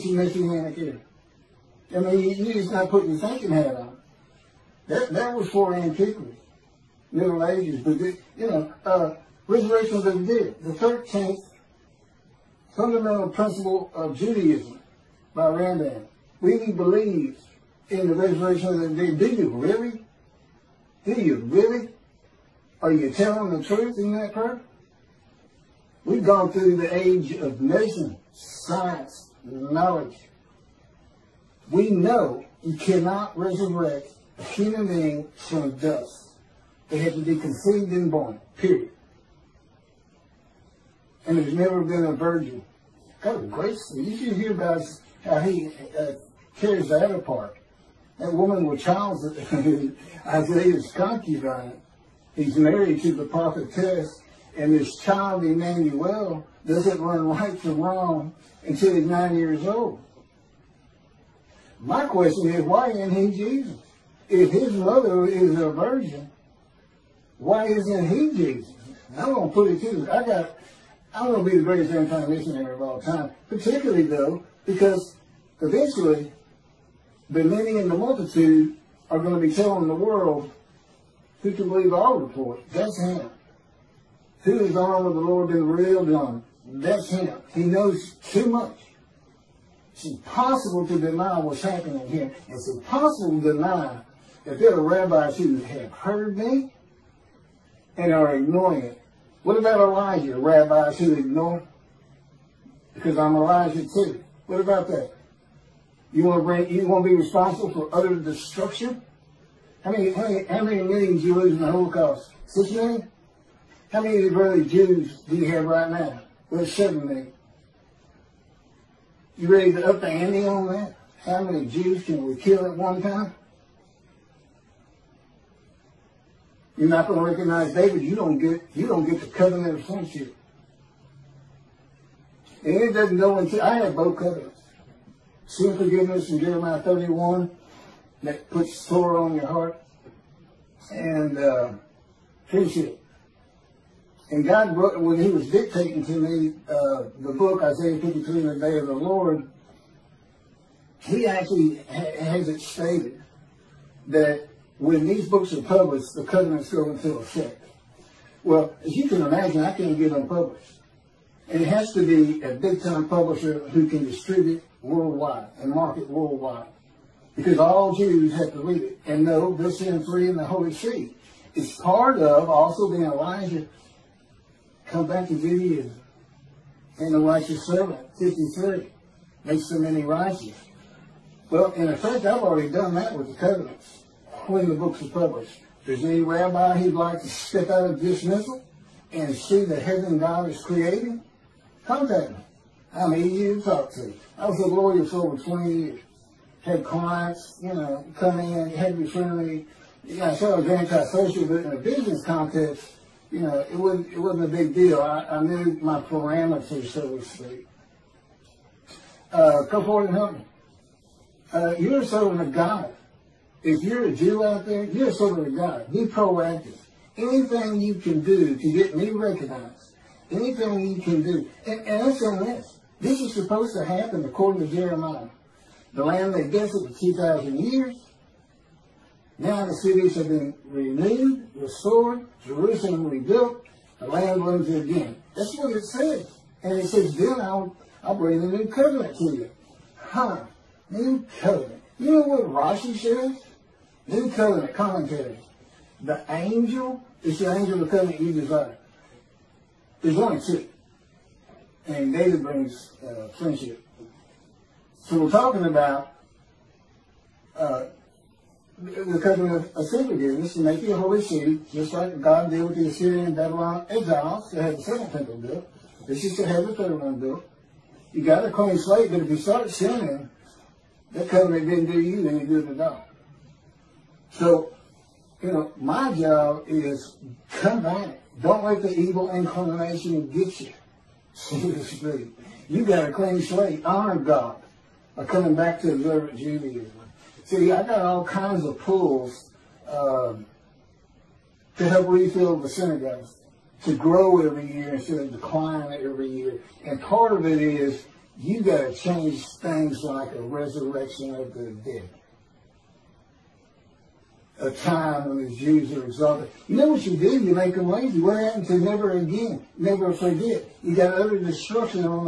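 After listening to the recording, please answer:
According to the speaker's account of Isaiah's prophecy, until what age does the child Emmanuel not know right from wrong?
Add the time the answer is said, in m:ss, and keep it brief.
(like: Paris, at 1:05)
9, at 0:59.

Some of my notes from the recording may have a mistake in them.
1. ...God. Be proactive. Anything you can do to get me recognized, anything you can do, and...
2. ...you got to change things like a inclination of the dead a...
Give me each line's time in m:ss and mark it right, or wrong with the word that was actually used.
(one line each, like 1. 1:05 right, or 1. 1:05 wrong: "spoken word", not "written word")
1. 3:35 right
2. 4:58 wrong: "resurrection", not "inclination".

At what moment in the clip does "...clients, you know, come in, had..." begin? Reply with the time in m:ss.
3:16.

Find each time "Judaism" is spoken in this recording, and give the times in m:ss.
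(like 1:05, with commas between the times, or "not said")
0:14, 2:55, 4:46.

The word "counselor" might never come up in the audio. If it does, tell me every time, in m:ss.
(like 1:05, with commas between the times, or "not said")
not said.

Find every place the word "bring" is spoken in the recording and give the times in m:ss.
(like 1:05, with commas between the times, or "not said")
1:46, 3:58, 4:12.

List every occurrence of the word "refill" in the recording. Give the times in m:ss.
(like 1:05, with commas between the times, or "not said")
4:52.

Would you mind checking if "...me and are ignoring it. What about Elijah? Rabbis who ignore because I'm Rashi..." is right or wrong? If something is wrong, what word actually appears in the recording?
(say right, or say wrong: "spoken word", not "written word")
wrong: "Elijah", not "Rashi".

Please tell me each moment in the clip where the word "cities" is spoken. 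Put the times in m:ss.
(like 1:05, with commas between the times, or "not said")
3:49.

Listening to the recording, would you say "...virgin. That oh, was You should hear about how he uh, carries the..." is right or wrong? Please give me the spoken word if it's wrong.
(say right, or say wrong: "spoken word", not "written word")
right.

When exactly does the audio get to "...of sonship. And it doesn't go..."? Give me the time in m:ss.
2:09.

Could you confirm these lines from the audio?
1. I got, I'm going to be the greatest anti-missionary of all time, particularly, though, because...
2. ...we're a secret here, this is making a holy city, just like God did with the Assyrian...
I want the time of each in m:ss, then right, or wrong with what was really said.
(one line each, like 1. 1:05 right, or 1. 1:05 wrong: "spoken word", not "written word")
1. 1:10 right
2. 4:19 right.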